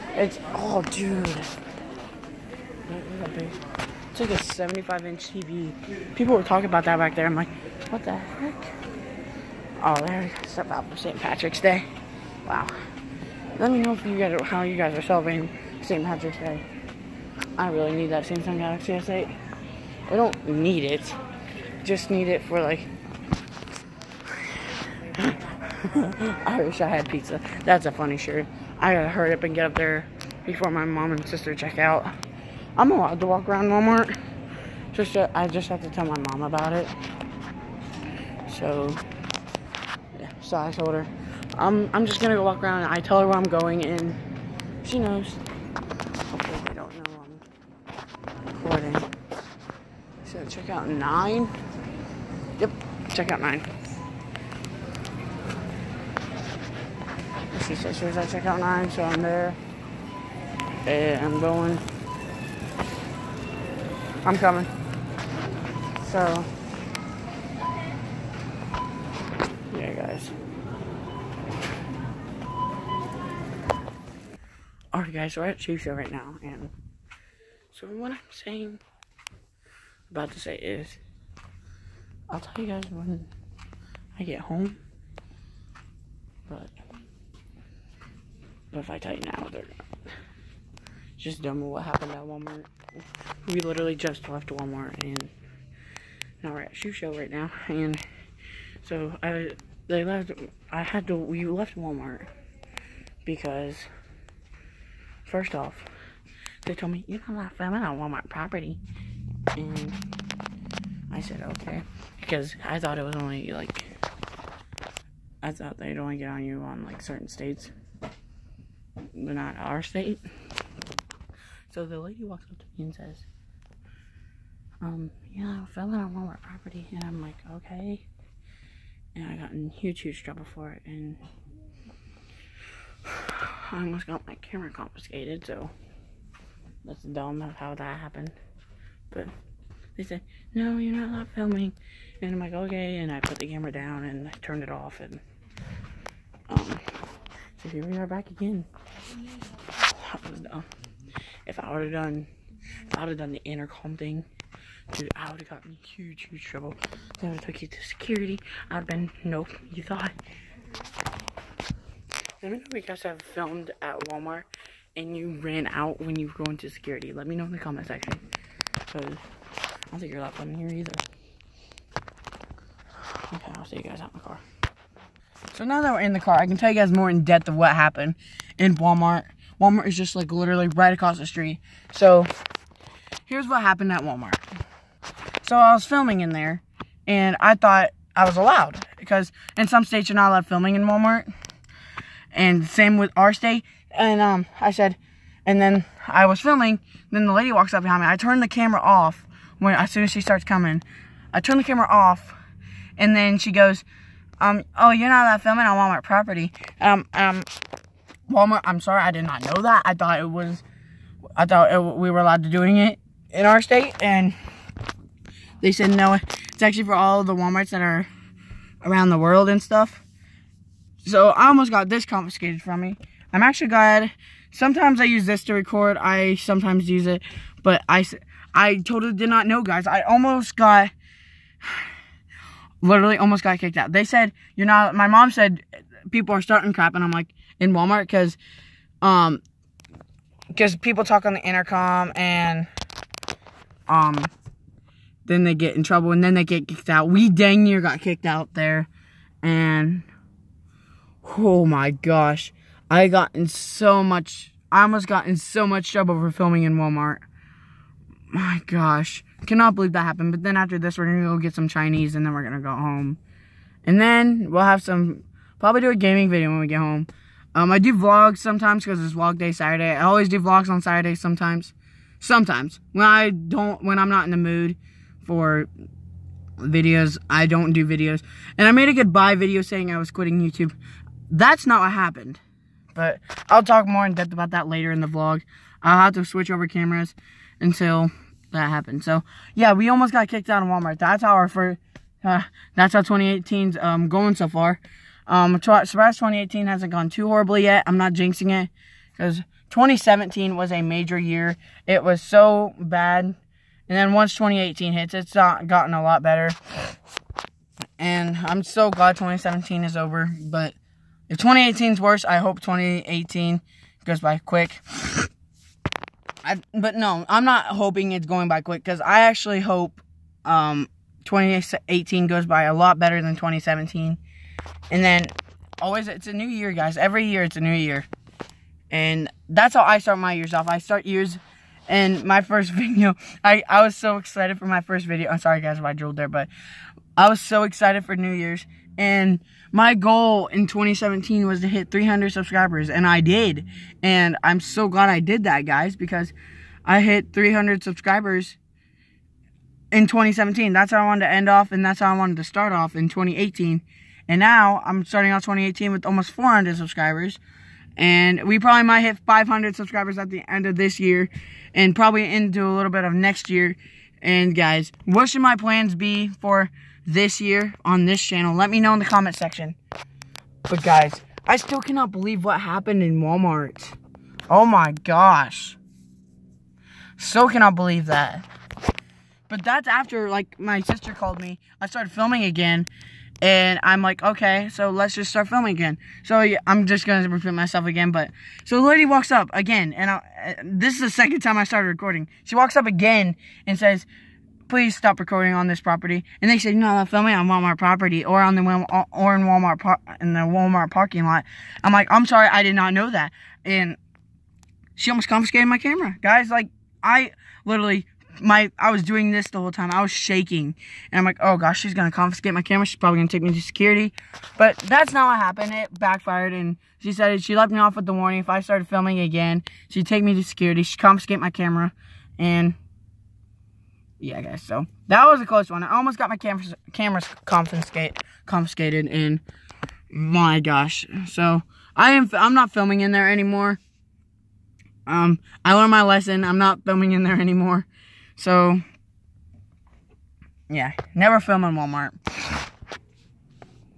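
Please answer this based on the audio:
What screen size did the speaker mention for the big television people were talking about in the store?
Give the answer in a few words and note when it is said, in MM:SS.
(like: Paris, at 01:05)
75 inch, at 00:04.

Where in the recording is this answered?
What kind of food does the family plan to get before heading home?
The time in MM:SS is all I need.
04:21.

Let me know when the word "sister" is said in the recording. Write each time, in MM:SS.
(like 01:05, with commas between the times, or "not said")
00:31, 06:20.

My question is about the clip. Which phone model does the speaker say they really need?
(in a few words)
Samsung Galaxy S8.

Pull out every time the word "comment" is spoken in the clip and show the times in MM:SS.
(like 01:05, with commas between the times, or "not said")
02:47, 06:09.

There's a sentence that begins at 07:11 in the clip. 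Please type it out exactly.
So I am, I'm not filming in there anymore.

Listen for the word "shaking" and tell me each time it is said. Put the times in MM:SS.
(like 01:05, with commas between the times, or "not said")
06:50.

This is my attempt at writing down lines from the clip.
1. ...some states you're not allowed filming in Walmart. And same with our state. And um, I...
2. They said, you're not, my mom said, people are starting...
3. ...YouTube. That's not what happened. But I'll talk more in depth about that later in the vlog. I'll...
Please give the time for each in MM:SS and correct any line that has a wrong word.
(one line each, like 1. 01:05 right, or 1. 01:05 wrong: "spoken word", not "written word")
1. 03:09 right
2. 03:53 right
3. 04:40 right.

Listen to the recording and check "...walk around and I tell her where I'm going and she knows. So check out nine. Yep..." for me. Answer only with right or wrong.
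right.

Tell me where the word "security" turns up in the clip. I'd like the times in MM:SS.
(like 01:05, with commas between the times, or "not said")
02:37, 02:46, 06:53, 07:00.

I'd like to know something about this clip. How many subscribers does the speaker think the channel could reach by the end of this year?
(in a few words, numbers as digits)
500.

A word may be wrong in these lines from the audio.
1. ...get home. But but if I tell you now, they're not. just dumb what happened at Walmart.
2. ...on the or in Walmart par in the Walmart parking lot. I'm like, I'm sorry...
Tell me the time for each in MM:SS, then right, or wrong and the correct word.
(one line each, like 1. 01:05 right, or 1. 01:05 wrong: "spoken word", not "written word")
1. 01:24 right
2. 06:38 right.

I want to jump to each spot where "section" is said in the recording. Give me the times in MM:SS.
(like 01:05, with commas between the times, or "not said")
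02:47, 06:09.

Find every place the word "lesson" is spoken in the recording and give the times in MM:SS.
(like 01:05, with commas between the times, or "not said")
07:16.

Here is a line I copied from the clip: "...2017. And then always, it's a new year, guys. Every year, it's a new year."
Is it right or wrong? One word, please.
right.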